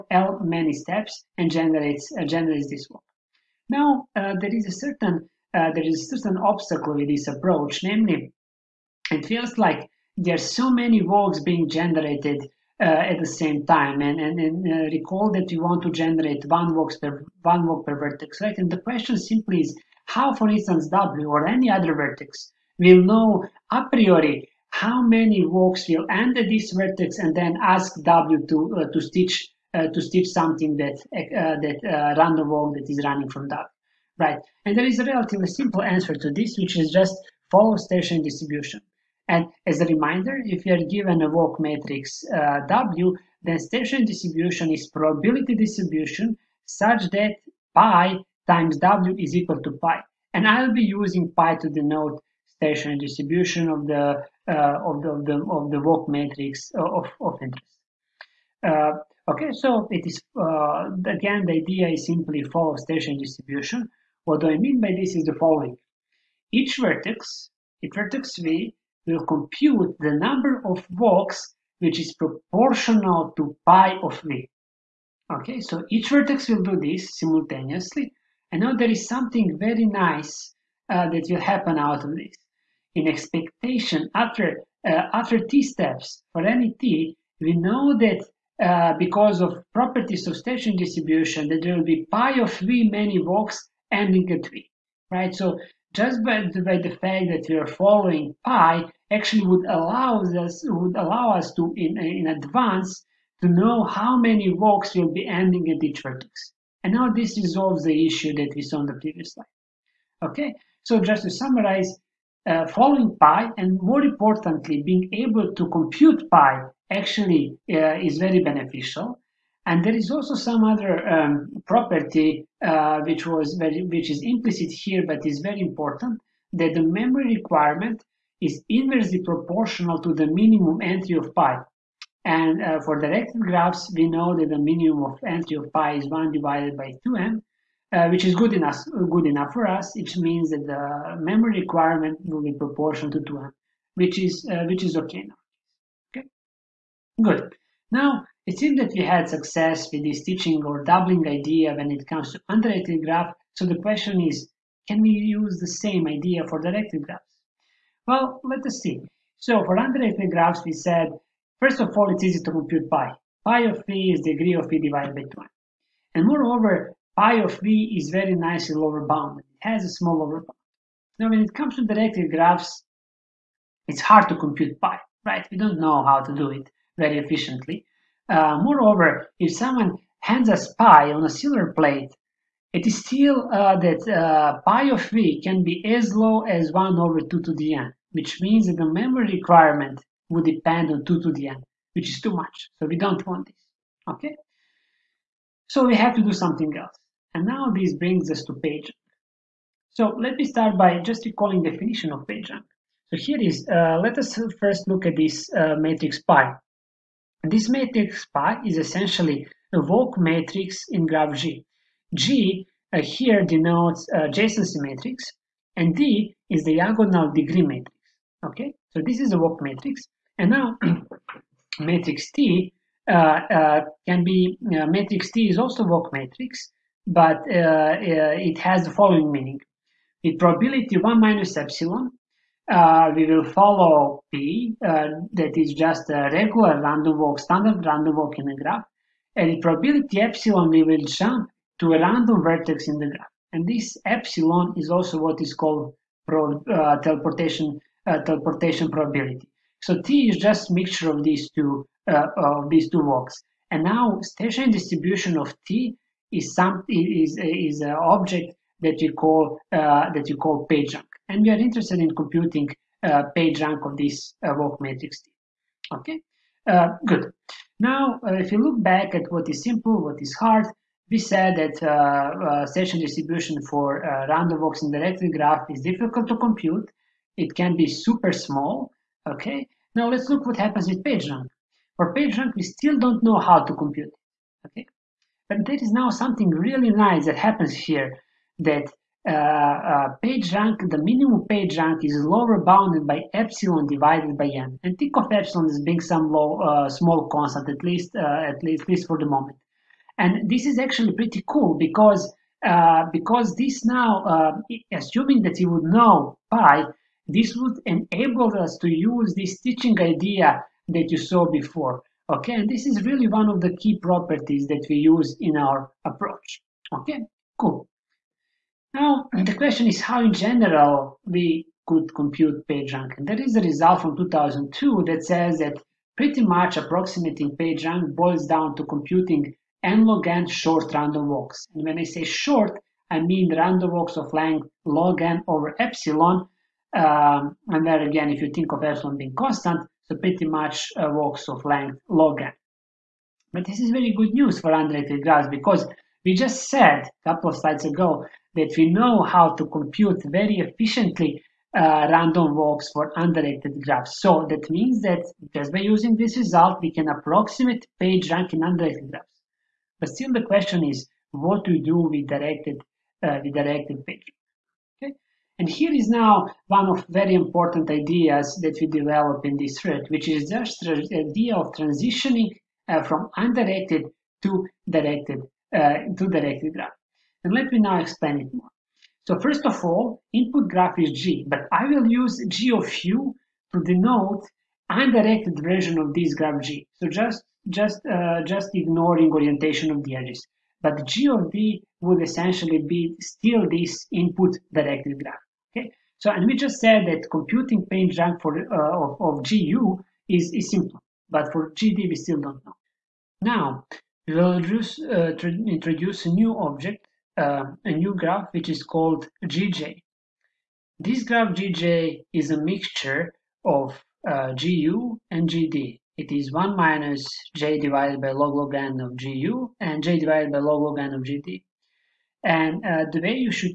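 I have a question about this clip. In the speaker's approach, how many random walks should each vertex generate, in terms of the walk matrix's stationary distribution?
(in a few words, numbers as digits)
Proportional to pi of v.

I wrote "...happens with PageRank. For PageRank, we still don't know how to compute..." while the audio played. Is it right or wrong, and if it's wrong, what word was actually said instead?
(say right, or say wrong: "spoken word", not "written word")
right.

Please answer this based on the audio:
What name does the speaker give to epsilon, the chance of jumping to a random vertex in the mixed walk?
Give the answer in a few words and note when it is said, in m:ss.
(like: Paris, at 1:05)
Teleportation probability, at 4:08.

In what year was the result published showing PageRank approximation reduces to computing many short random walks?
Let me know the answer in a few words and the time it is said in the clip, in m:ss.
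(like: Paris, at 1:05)
2002, at 5:24.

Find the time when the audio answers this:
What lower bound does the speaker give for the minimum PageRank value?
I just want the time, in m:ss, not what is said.
4:53.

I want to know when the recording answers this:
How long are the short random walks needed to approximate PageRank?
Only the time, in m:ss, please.
5:34.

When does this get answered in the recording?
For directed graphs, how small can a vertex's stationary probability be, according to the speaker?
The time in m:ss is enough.
3:06.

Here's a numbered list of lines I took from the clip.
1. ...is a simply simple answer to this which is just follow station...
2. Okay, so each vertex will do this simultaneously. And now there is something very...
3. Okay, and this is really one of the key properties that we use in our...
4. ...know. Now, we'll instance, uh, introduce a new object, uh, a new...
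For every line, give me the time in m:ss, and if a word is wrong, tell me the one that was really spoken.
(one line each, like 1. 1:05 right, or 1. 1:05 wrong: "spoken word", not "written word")
1. 0:34 wrong: "relatively", not "simply"
2. 1:15 right
3. 5:12 right
4. 6:42 wrong: "introduce", not "instance".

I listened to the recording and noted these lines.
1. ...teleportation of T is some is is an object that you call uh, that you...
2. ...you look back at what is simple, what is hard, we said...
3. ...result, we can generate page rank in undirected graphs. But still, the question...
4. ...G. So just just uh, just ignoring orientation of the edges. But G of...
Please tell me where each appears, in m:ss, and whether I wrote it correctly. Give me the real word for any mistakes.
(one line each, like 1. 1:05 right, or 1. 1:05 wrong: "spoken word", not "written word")
1. 4:14 wrong: "distribution", not "teleportation"
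2. 4:28 right
3. 5:56 wrong: "approximate", not "generate"
4. 6:26 right.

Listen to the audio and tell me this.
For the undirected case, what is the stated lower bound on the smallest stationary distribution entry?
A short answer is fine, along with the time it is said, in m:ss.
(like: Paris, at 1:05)
1 divided by 2m, at 2:16.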